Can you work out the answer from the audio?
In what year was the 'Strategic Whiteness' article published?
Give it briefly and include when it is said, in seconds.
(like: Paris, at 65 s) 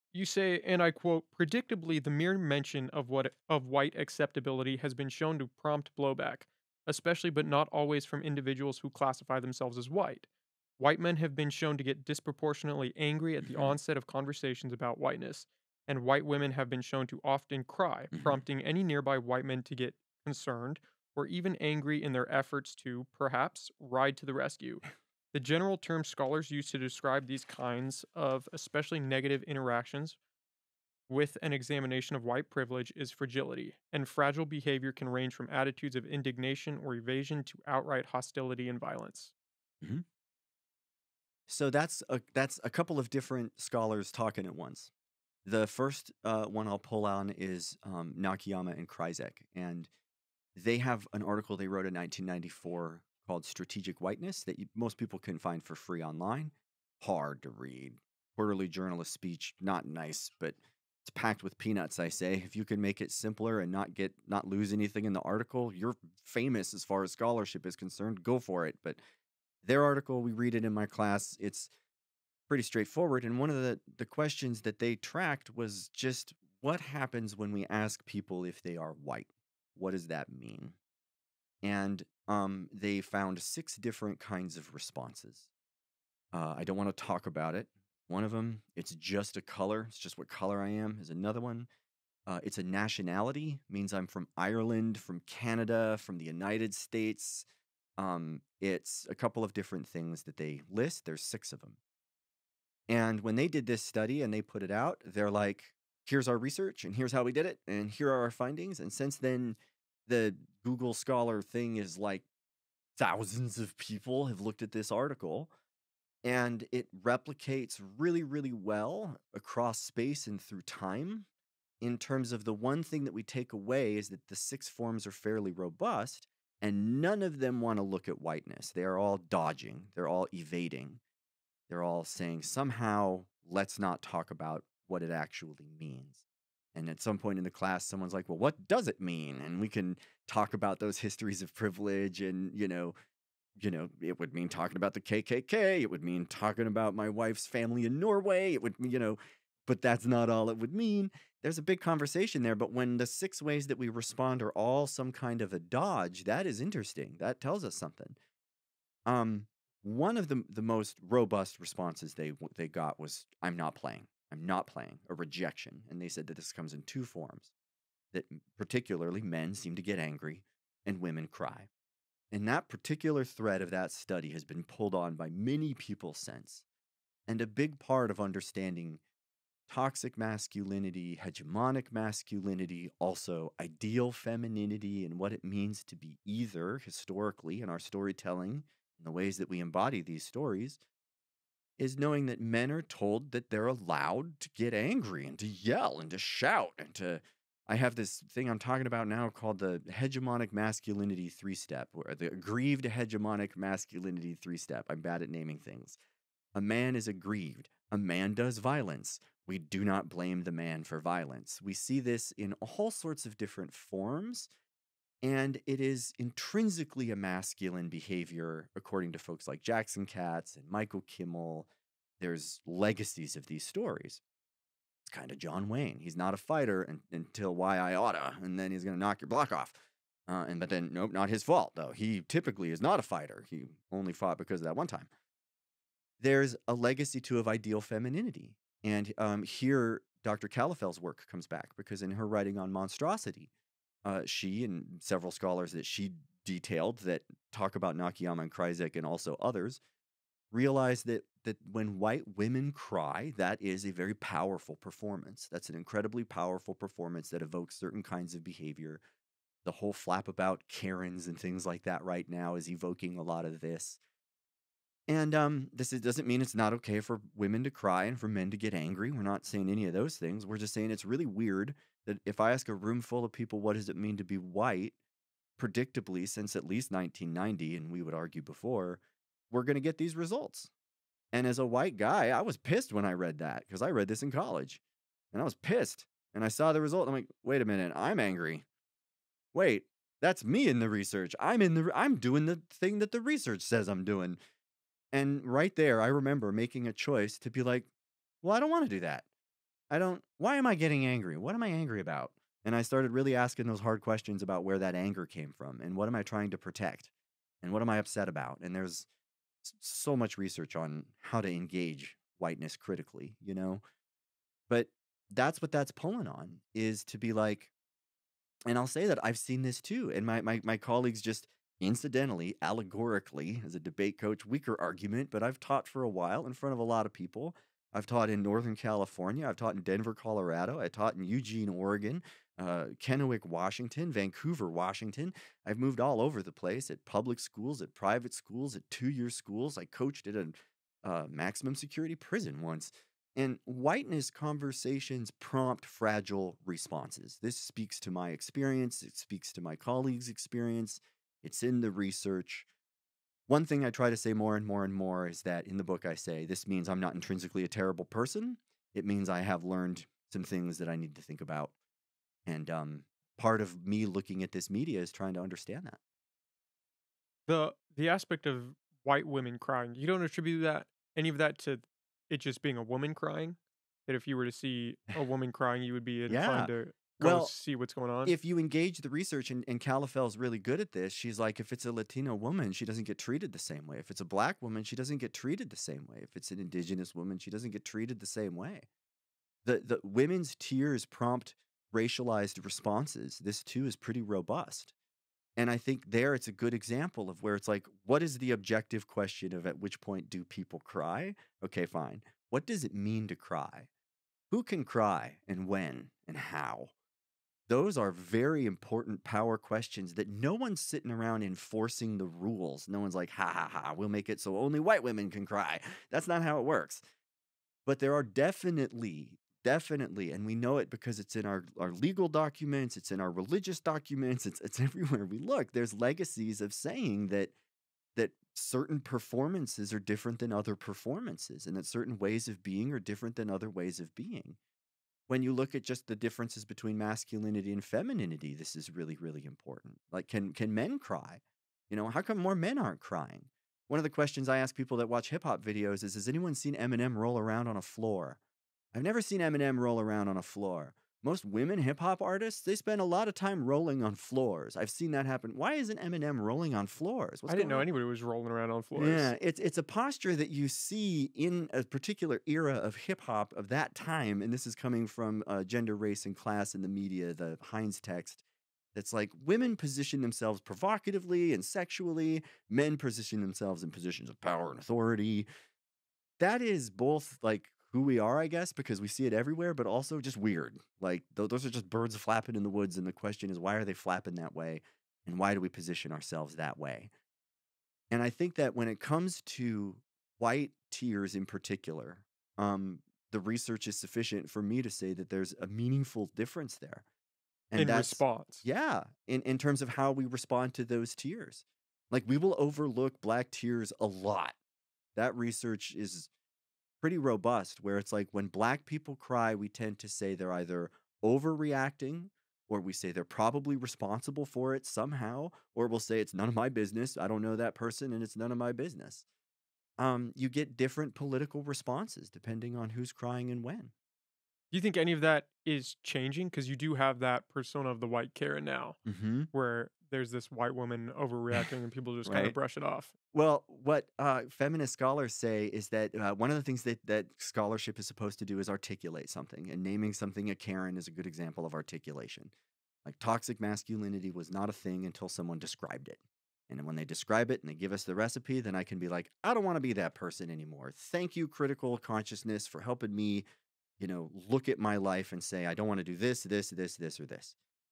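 1994, at 51 s.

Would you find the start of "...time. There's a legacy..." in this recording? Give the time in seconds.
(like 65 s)
234 s.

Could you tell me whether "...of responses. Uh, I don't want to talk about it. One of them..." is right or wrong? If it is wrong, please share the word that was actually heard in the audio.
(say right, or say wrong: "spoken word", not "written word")
right.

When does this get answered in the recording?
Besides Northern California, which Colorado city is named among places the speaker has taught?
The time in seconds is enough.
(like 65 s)
329 s.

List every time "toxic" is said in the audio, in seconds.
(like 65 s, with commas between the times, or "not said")
179 s, 543 s.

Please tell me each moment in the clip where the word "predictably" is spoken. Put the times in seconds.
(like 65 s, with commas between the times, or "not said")
1 s, 275 s.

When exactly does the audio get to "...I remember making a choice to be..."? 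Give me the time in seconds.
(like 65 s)
296 s.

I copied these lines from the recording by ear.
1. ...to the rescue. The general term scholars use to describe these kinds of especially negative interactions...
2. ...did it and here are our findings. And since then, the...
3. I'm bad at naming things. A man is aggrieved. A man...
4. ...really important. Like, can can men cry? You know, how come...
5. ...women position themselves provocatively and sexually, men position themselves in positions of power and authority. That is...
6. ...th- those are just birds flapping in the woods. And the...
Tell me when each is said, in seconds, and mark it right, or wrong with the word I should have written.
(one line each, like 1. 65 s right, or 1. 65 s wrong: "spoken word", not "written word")
1. 24 s right
2. 107 s right
3. 204 s right
4. 439 s right
5. 469 s right
6. 481 s right.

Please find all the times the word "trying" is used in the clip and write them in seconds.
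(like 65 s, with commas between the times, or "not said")
306 s, 365 s.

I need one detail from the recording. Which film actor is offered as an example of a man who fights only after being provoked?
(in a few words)
John Wayne.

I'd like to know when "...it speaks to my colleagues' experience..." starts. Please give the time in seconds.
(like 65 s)
349 s.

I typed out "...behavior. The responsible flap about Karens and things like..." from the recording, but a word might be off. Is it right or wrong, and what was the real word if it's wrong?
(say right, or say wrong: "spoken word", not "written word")
wrong: "whole", not "responsible".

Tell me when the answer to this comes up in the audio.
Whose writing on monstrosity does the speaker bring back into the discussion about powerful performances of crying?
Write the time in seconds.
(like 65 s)
240 s.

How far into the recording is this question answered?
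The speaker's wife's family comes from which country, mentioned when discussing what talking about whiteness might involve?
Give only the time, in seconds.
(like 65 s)
147 s.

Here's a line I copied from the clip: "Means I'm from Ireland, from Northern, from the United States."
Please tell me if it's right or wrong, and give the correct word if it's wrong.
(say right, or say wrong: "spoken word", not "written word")
wrong: "Canada", not "Northern".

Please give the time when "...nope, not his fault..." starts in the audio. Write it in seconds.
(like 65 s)
230 s.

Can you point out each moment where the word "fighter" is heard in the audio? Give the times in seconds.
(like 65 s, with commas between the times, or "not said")
226 s, 233 s.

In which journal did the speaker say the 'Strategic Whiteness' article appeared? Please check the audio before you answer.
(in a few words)
Quarterly Journal of Speech.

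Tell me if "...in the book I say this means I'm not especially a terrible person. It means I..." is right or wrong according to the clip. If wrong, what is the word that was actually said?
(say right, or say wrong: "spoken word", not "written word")
wrong: "intrinsically", not "especially".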